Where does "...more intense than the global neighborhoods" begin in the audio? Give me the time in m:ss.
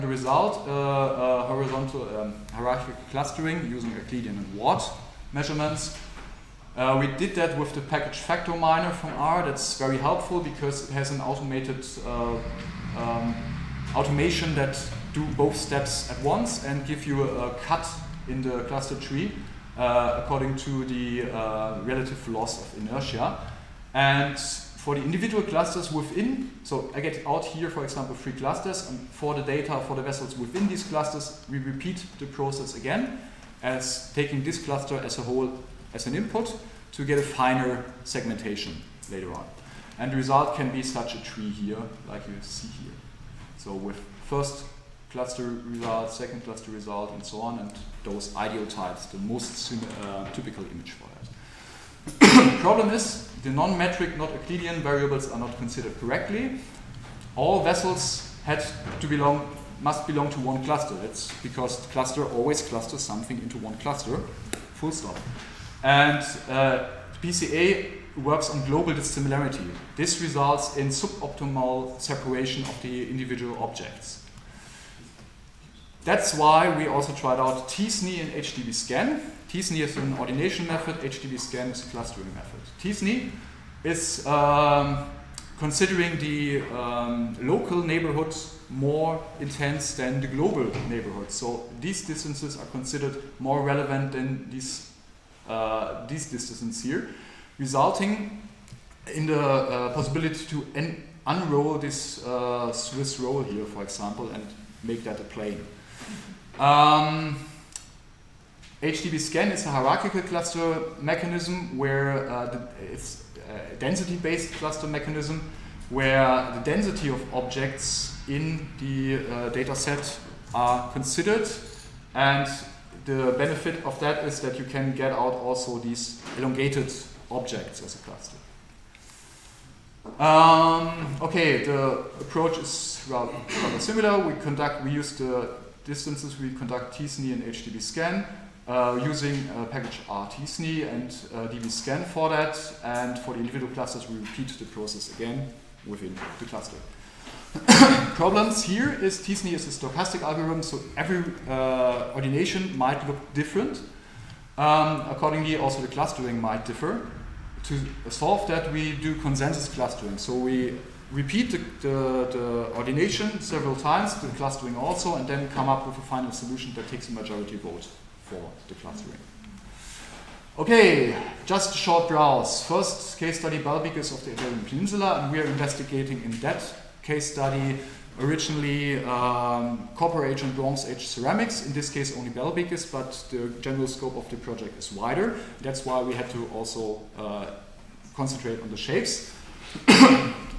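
1:28.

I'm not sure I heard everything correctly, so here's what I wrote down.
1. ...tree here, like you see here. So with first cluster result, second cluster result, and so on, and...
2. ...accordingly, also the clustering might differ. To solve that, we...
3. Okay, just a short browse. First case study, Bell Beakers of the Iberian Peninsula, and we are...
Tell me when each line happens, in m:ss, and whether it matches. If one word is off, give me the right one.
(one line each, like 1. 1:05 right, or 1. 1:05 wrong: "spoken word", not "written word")
1. 0:41 right
2. 2:35 right
3. 2:50 right.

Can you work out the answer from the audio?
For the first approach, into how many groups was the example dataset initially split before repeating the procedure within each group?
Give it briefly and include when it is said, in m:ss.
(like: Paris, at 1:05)
3, at 0:28.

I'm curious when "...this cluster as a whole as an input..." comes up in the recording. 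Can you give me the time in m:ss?
0:34.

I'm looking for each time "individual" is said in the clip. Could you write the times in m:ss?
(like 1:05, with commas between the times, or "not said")
0:25, 1:13, 2:23.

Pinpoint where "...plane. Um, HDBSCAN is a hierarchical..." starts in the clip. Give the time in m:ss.
1:45.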